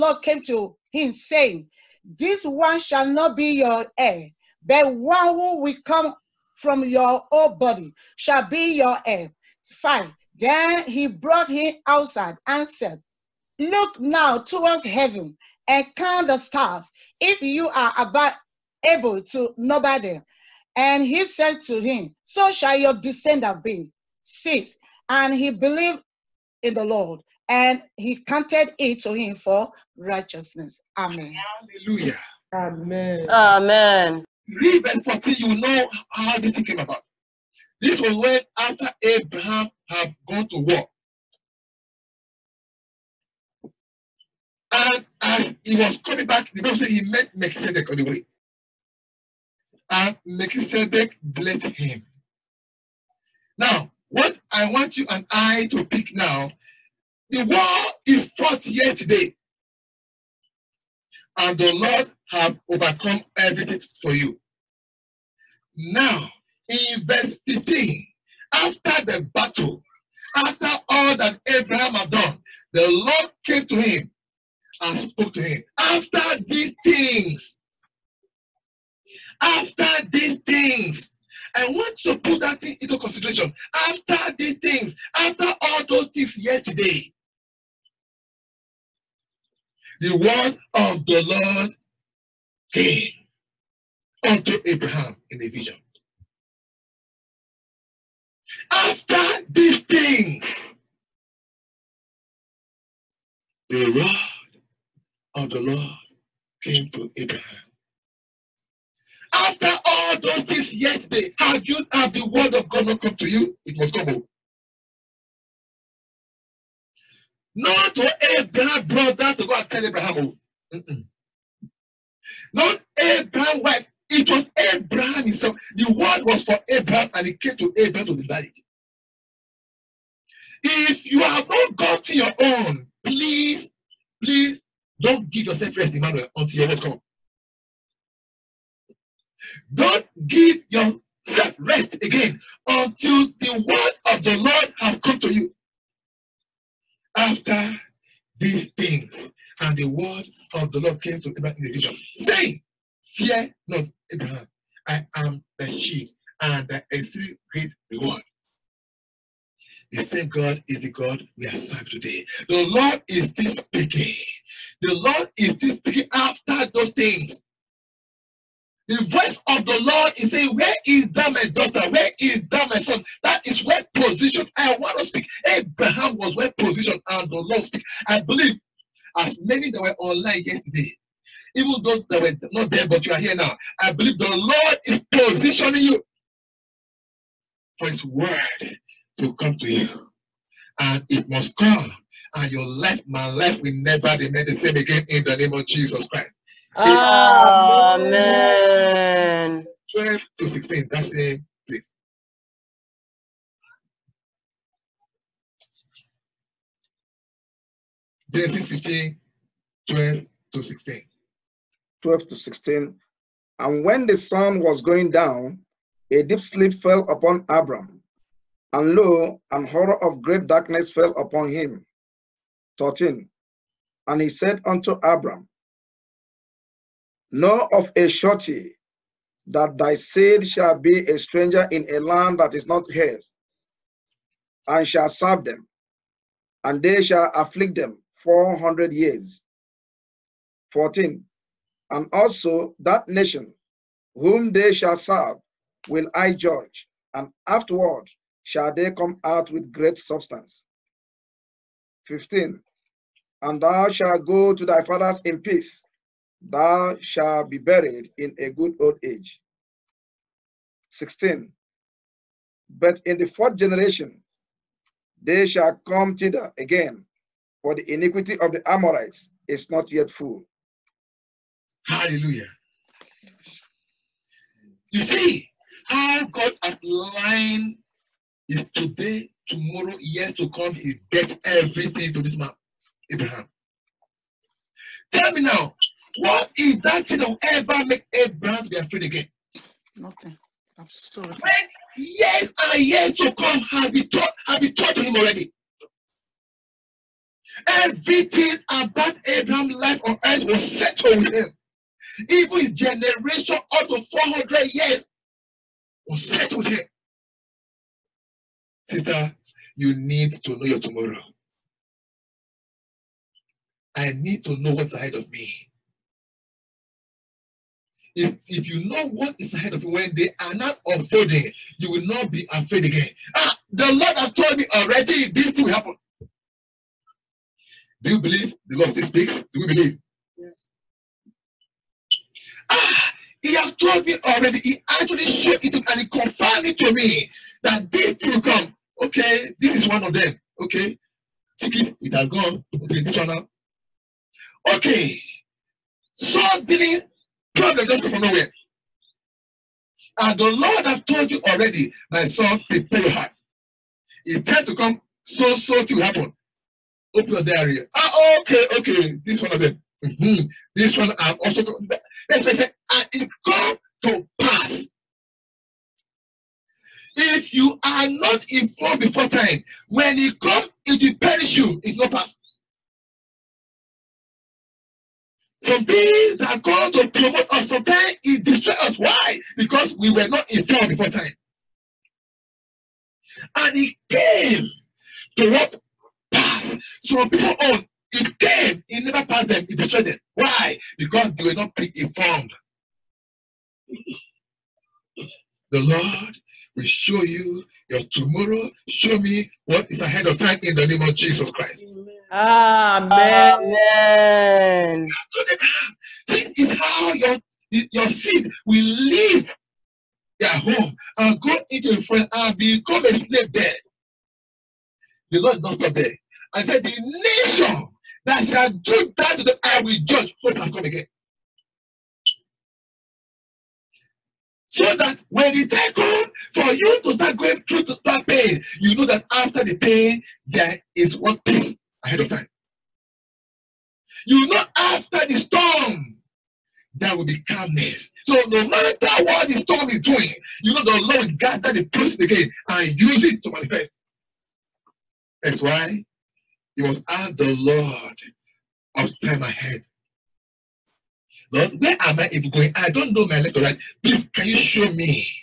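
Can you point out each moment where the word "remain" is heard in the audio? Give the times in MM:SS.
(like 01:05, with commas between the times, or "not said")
03:14.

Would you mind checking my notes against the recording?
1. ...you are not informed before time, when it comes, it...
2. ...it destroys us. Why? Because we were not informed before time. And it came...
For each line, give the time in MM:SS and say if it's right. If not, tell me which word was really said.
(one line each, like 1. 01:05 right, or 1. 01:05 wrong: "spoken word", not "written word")
1. 06:07 right
2. 06:18 right.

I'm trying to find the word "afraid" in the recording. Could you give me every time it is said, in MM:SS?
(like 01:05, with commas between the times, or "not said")
04:48, 05:22.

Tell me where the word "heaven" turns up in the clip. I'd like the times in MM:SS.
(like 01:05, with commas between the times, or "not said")
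00:14.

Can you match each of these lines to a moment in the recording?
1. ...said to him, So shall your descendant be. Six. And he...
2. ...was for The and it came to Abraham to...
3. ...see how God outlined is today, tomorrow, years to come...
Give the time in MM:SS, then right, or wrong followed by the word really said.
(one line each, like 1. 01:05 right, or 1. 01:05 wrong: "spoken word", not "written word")
1. 00:21 right
2. 02:06 wrong: "Abraham", not "The"
3. 04:35 right.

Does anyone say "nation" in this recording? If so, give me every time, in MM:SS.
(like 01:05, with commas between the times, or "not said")
04:03, 06:56.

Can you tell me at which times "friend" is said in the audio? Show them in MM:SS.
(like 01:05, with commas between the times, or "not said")
06:52.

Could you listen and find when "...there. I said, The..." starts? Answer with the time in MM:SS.
06:55.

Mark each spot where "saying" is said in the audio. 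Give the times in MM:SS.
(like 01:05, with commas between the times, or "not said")
00:01, 02:32, 02:50.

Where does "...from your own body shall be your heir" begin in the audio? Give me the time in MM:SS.
00:06.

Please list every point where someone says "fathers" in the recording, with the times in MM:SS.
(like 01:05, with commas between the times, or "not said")
04:14.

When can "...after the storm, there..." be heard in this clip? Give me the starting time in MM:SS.
07:14.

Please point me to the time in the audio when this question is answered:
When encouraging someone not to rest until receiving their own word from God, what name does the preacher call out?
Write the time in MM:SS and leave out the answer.
02:15.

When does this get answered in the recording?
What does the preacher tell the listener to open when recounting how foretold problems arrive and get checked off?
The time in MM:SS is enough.
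05:57.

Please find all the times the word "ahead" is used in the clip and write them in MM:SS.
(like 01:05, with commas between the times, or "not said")
05:14, 05:19, 06:39, 07:12, 07:29.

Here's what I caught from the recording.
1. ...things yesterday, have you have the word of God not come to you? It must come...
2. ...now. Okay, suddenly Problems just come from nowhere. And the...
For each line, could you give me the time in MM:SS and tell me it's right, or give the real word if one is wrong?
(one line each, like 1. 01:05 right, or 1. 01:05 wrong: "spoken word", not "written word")
1. 01:50 right
2. 05:43 right.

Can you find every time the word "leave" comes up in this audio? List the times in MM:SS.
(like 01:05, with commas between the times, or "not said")
06:48.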